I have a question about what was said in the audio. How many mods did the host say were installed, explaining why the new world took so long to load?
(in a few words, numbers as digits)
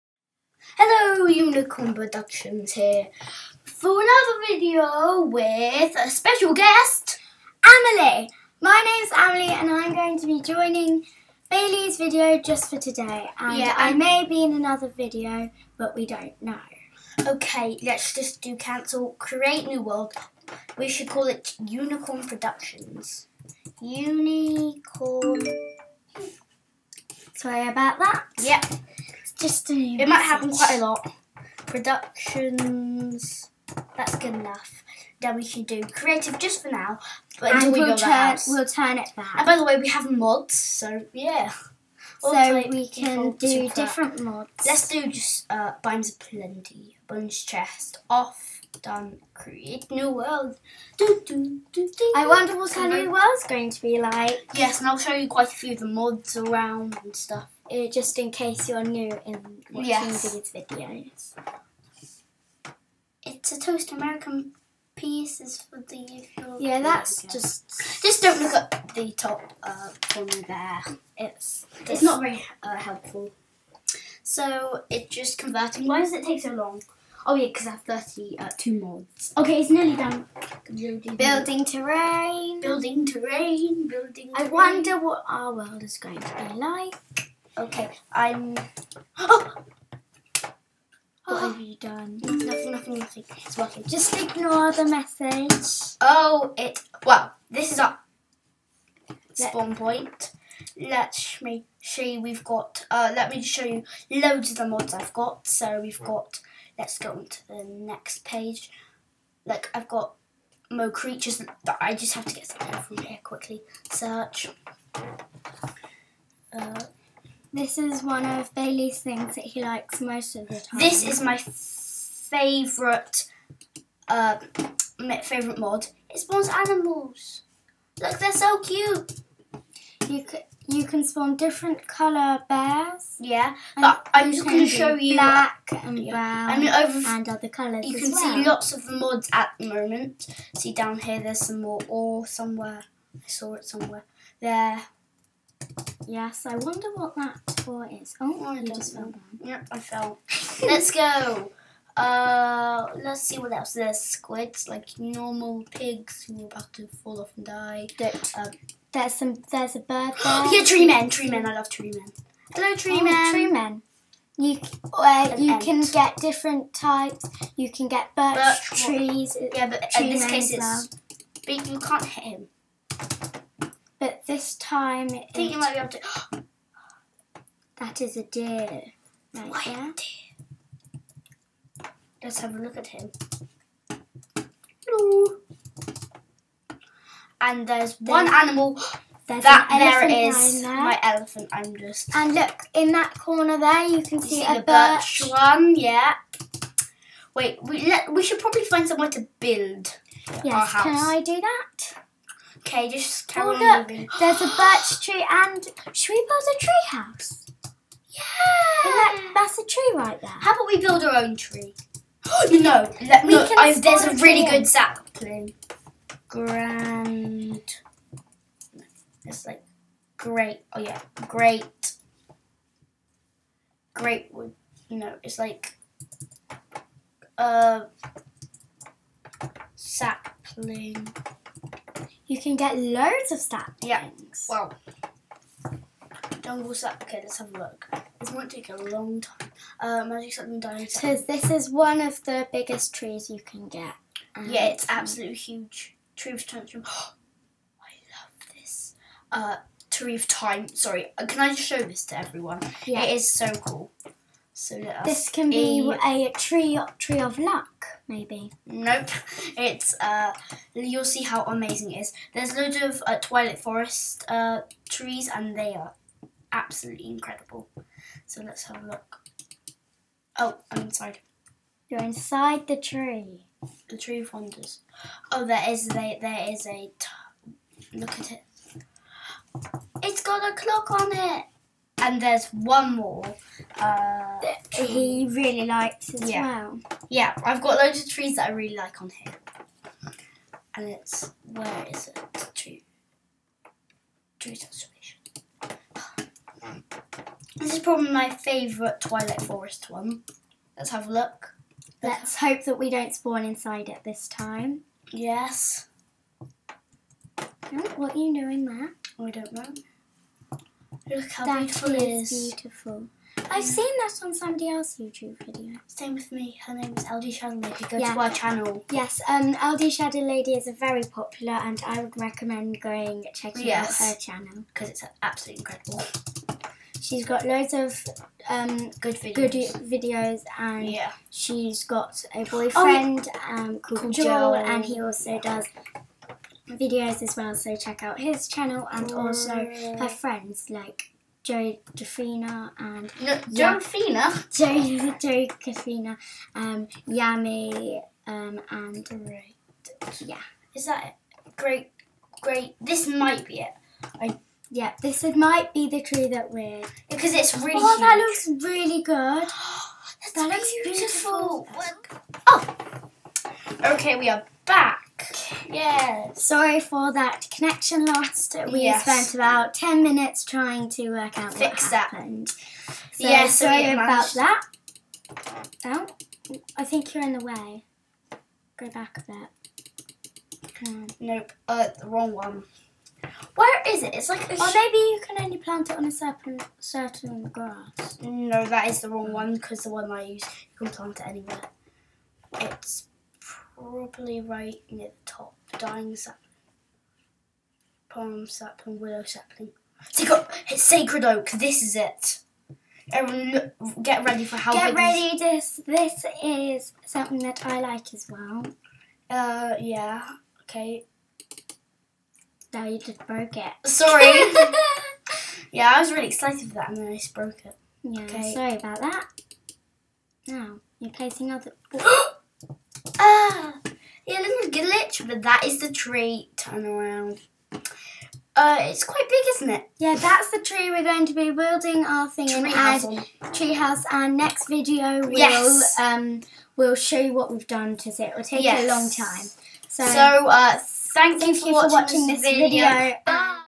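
32.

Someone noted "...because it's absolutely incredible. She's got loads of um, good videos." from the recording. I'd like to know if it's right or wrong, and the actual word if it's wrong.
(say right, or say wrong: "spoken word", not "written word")
right.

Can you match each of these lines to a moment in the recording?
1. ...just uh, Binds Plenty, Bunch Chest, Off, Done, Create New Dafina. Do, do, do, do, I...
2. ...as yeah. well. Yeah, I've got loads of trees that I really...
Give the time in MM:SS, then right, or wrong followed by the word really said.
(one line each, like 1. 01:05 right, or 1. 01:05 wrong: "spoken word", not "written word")
1. 00:45 wrong: "World", not "Dafina"
2. 04:46 right.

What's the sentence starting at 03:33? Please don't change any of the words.
there's a, a really good sapling.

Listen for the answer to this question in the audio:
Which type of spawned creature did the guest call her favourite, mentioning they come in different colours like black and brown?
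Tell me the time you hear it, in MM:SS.
02:12.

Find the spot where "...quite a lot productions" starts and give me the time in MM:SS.
00:30.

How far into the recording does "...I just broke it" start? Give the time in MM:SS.
06:57.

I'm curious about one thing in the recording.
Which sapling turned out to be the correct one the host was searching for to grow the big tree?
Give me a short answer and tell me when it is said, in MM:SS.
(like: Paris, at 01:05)
Sacred oak, at 06:40.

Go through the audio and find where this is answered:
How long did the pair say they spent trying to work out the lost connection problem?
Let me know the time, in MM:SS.
06:09.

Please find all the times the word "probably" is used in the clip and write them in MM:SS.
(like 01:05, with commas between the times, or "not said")
03:18, 04:57, 06:33.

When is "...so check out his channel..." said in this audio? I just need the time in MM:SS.
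05:37.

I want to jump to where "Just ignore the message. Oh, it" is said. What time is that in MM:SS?
01:33.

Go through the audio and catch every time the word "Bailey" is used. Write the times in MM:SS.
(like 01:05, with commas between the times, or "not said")
00:11, 01:58.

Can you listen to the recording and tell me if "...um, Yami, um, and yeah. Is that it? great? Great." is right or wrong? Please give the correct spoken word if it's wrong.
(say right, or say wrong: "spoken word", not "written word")
right.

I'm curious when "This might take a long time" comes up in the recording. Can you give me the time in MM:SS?
03:58.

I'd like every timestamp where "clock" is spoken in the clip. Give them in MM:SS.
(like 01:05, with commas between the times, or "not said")
04:40.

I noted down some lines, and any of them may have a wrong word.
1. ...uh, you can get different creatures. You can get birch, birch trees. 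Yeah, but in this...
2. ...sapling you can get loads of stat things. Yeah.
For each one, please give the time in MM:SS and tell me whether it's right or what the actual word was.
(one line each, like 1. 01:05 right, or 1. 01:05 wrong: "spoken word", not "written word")
1. 02:44 wrong: "types", not "creatures"
2. 03:49 right.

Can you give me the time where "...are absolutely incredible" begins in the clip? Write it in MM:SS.
04:25.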